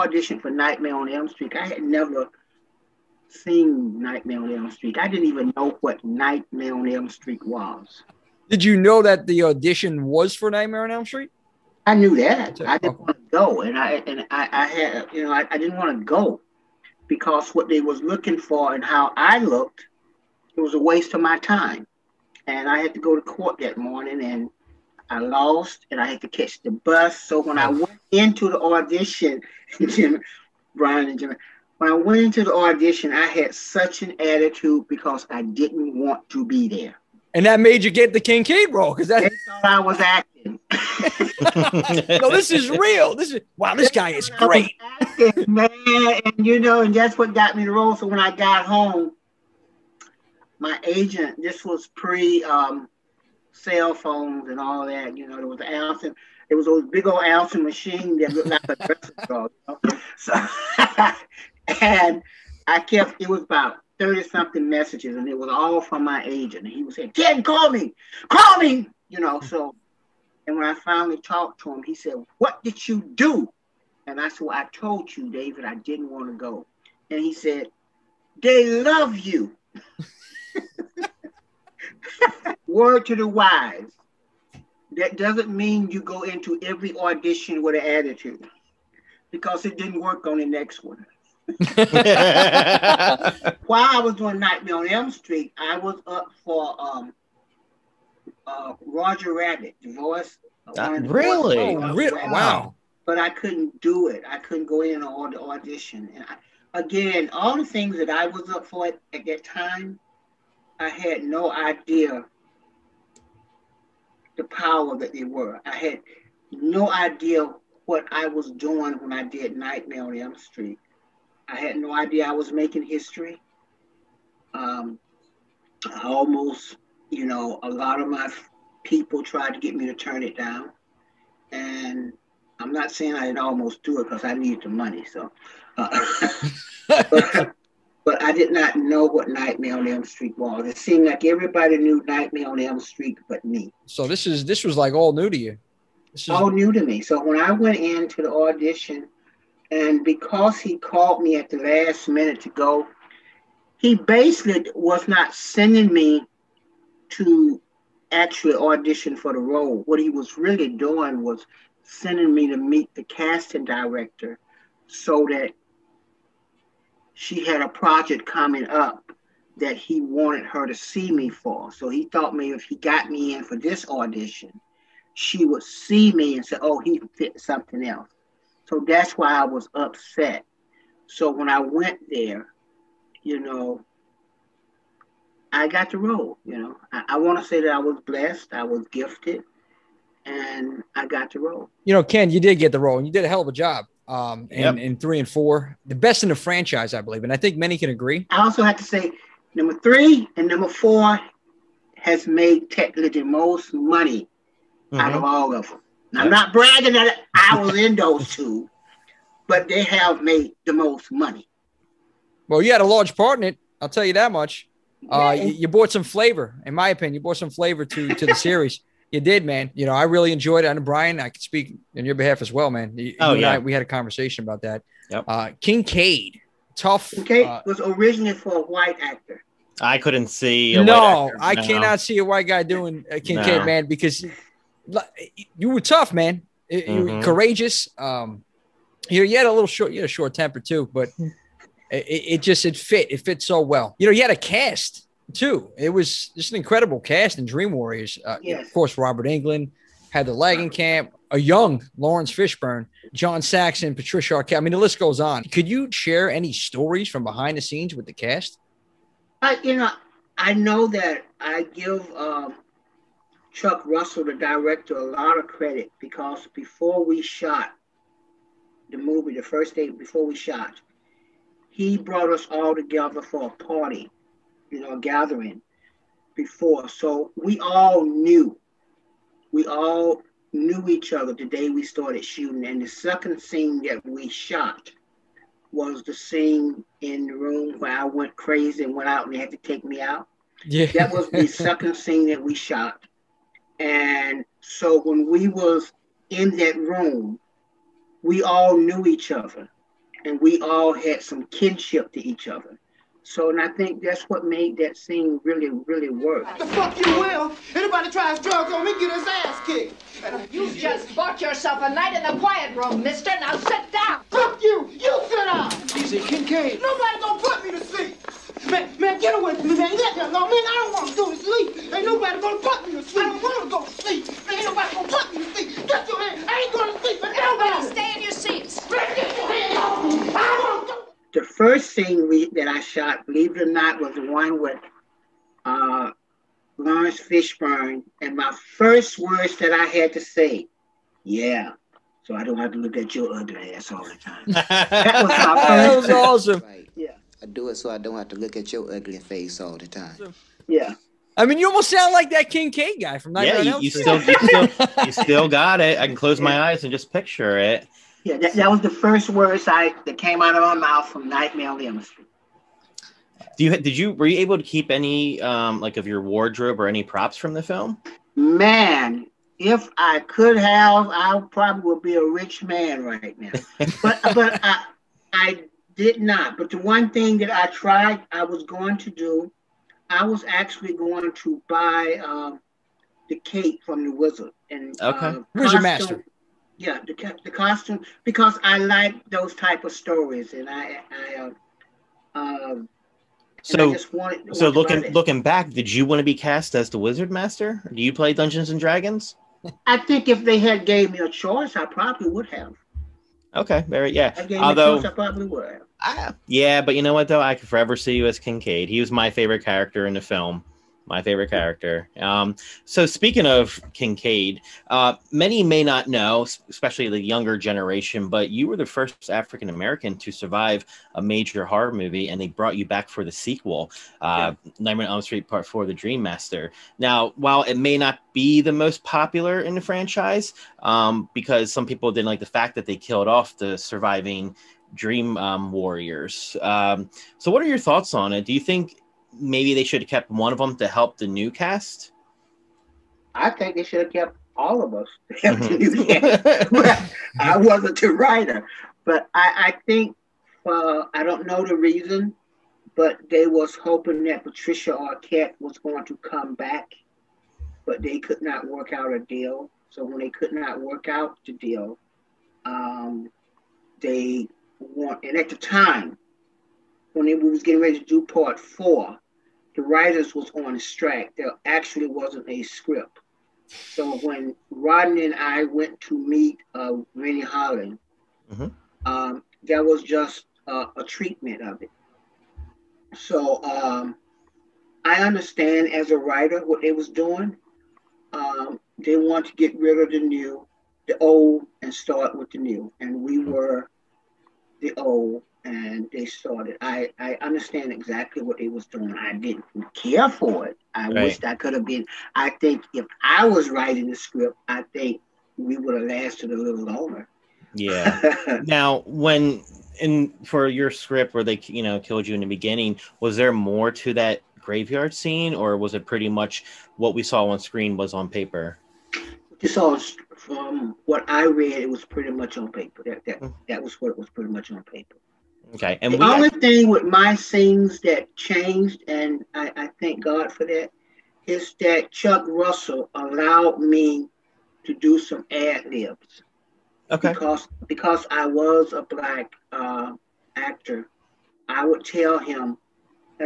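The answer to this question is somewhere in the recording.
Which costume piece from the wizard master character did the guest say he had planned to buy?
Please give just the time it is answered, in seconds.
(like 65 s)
383 s.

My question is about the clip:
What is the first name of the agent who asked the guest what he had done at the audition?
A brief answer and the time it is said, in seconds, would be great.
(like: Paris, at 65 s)
David, at 75 s.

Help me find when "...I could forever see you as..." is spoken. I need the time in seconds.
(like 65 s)
407 s.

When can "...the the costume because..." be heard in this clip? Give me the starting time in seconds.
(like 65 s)
387 s.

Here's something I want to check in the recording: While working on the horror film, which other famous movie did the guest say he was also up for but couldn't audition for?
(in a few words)
Roger Rabbit.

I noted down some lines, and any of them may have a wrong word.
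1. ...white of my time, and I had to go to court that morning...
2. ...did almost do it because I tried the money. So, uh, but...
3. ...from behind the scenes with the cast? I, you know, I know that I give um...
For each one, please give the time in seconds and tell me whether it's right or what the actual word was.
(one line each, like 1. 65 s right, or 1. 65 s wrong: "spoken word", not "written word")
1. 20 s wrong: "waste", not "white"
2. 133 s wrong: "needed", not "tried"
3. 257 s right.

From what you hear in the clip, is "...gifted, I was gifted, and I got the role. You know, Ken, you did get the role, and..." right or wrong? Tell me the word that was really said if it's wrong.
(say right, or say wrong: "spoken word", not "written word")
wrong: "blessed", not "gifted".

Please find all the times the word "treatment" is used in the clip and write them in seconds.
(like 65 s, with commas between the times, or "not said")
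481 s.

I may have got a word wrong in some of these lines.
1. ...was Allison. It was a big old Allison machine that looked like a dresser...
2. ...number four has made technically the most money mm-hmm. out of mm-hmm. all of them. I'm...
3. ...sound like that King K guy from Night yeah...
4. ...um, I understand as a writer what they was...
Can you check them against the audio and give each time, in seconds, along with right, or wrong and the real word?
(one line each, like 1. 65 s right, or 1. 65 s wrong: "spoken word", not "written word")
1. 55 s right
2. 200 s right
3. 351 s right
4. 483 s right.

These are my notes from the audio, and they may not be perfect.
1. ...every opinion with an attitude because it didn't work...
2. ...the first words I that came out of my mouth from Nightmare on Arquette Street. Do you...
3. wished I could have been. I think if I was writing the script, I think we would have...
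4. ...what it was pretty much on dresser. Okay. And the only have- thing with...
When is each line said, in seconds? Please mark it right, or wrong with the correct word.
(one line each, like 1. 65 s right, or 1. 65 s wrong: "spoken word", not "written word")
1. 86 s wrong: "audition", not "opinion"
2. 358 s wrong: "Elm", not "Arquette"
3. 501 s right
4. 523 s wrong: "paper", not "dresser".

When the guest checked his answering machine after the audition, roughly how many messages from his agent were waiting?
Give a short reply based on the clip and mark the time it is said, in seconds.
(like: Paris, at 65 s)
30 something, at 63 s.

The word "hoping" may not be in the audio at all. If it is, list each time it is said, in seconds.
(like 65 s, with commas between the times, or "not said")
453 s.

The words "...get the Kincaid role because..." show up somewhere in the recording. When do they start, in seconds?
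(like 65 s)
37 s.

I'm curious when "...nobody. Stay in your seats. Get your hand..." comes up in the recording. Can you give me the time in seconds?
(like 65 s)
327 s.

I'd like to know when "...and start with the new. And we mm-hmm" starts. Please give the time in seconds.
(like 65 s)
491 s.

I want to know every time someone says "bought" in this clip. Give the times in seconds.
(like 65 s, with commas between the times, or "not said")
217 s, 311 s.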